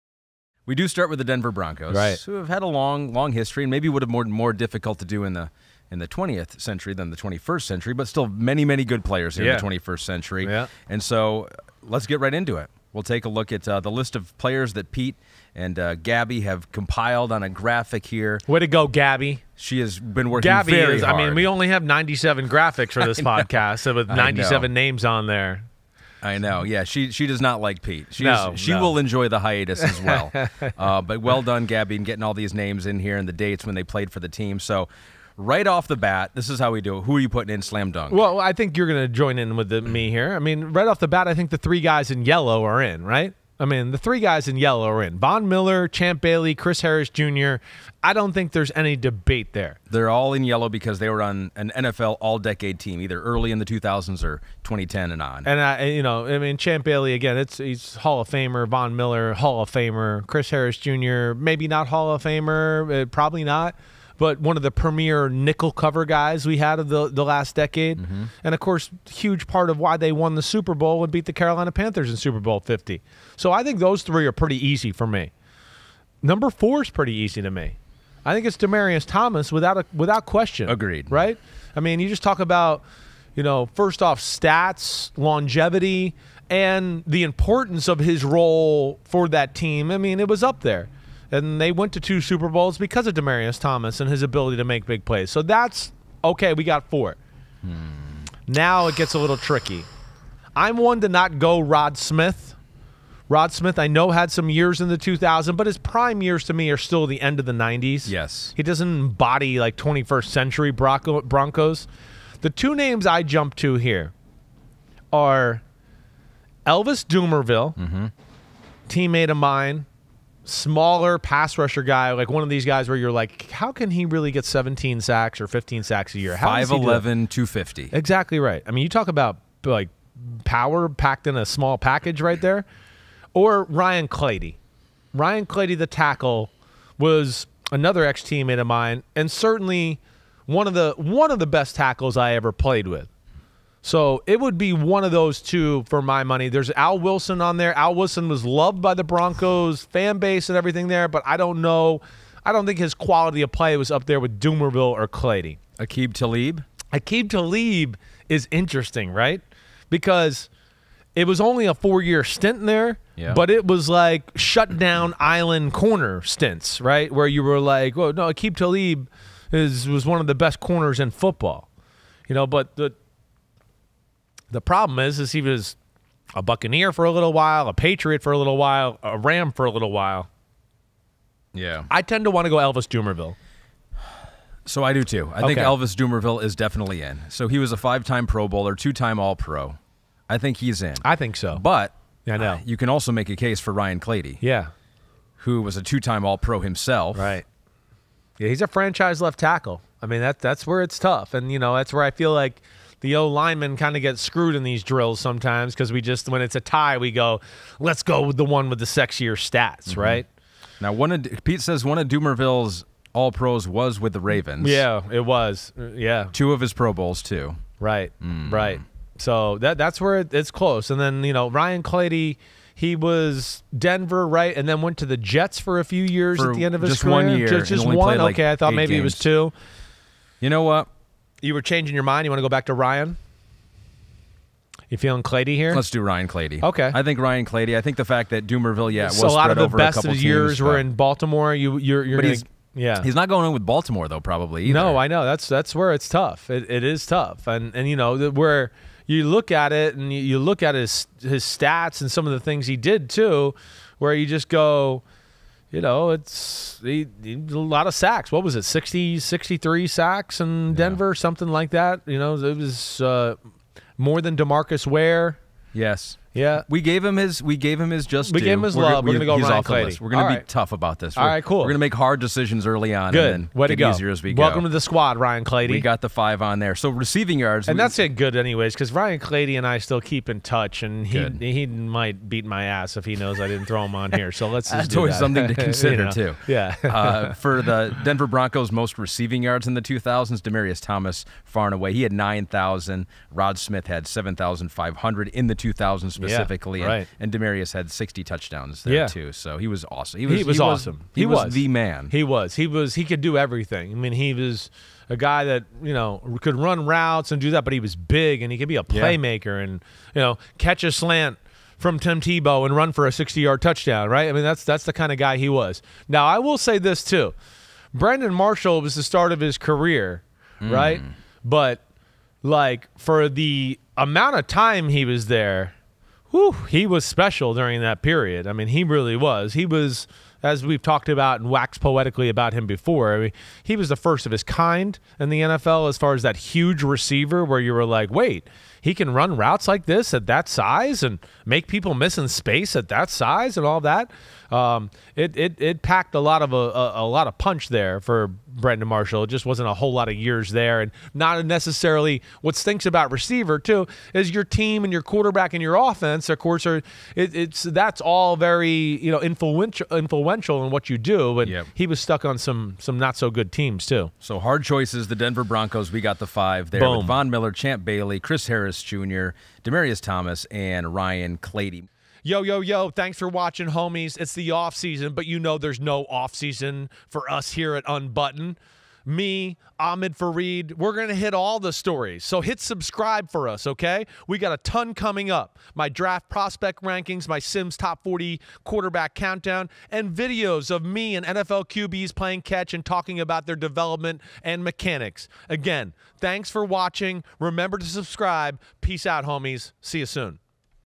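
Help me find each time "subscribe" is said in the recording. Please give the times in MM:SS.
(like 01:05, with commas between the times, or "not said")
06:22, 06:37.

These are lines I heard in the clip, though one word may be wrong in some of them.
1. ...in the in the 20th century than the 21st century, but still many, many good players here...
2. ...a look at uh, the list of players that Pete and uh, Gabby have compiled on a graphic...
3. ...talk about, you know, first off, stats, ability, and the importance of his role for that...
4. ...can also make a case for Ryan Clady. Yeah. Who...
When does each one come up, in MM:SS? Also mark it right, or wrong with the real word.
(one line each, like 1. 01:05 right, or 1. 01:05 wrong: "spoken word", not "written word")
1. 00:05 right
2. 00:13 right
3. 01:22 wrong: "longevity", not "ability"
4. 03:12 right.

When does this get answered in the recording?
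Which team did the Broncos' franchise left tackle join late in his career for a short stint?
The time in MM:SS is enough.
03:45.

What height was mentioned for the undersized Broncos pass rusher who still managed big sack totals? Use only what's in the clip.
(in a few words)
5'11.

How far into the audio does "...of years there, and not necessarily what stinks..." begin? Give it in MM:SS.
05:50.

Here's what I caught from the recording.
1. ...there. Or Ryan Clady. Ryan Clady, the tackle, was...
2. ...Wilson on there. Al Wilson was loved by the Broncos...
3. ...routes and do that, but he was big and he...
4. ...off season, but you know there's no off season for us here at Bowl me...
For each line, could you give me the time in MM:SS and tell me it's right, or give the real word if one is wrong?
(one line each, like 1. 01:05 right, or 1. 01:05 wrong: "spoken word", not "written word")
1. 02:12 right
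2. 02:26 right
3. 05:06 right
4. 06:14 wrong: "Unbutton", not "Bowl".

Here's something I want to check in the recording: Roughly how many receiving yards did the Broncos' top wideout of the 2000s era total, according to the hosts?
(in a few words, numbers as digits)
9,000.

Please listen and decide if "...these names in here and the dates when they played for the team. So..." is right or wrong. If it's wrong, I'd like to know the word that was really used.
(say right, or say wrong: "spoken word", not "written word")
right.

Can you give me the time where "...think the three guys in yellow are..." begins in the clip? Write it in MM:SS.
00:41.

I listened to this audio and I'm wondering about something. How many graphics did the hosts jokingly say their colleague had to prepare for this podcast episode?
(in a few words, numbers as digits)
97.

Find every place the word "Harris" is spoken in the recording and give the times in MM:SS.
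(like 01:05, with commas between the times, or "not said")
00:46, 01:00, 06:08.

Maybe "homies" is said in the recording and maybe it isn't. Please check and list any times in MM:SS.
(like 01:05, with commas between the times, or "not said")
06:13, 06:39.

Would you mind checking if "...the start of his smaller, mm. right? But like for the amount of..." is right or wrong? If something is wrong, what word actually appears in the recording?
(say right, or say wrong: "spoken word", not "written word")
wrong: "career", not "smaller".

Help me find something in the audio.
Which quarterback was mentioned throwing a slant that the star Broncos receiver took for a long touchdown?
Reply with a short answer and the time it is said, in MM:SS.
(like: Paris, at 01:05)
Tim Tebow, at 05:11.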